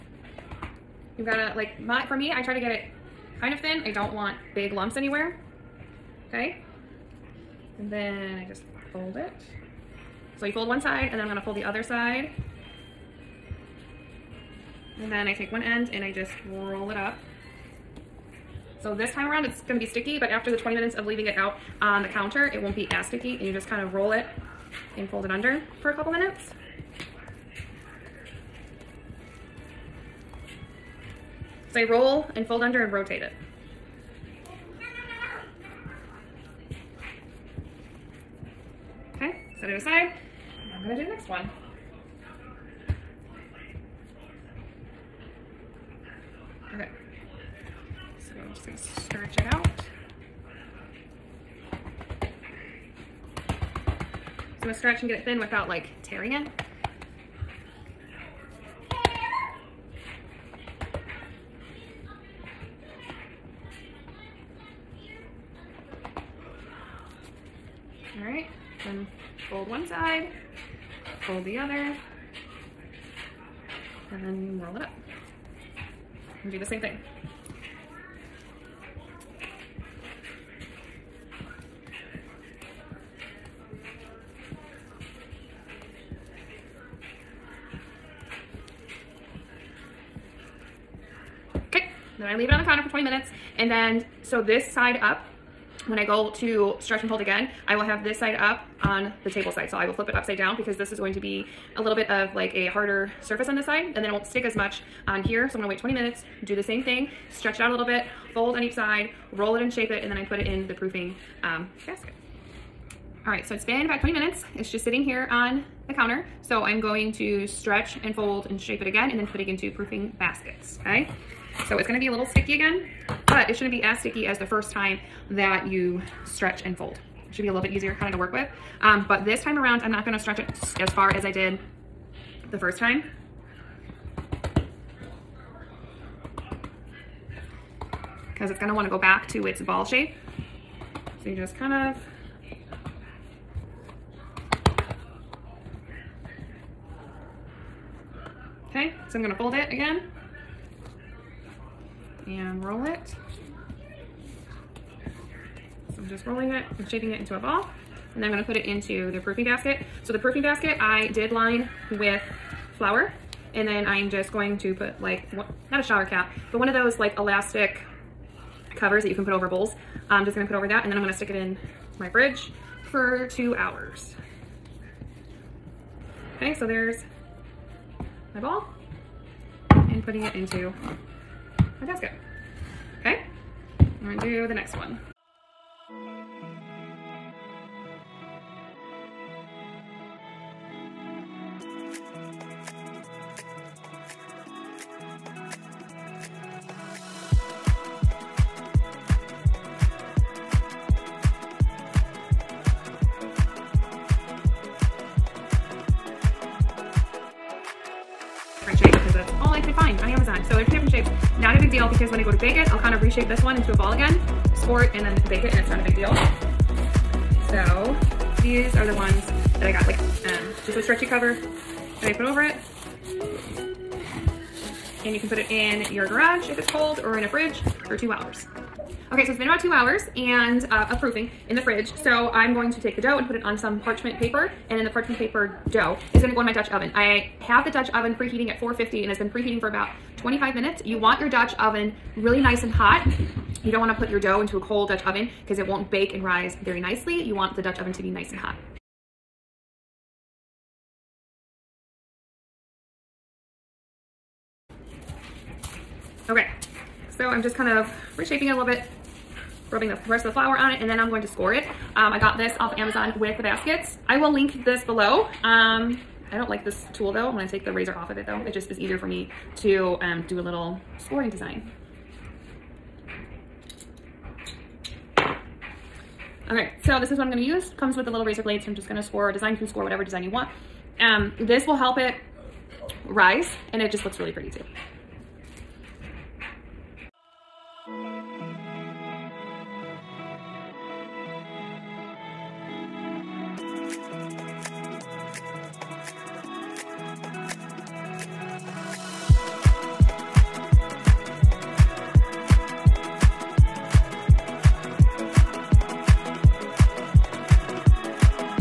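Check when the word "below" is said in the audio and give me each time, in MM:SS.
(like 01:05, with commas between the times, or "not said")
04:24.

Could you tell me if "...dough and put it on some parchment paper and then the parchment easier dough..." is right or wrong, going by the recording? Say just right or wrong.
wrong.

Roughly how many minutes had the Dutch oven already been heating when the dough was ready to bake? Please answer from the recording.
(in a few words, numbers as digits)
25 minutes.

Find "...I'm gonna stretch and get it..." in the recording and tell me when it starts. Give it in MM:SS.
00:54.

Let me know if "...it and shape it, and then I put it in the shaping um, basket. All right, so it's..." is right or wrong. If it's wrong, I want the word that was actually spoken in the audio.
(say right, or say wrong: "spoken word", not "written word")
wrong: "proofing", not "shaping".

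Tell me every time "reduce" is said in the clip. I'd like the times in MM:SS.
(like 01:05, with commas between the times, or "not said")
not said.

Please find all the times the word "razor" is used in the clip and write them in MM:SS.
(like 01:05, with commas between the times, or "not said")
04:27, 04:38.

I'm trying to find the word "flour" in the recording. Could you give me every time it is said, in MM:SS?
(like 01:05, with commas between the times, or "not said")
02:42, 04:20.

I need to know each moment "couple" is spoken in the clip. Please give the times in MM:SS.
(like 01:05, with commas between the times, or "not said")
00:25.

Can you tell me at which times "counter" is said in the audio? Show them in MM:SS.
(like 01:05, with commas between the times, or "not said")
00:22, 01:32, 01:55.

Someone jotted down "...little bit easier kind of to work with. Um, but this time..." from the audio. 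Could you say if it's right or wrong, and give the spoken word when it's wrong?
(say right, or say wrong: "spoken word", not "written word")
right.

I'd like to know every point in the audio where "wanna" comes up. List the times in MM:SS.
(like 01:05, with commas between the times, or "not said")
02:18, 04:03.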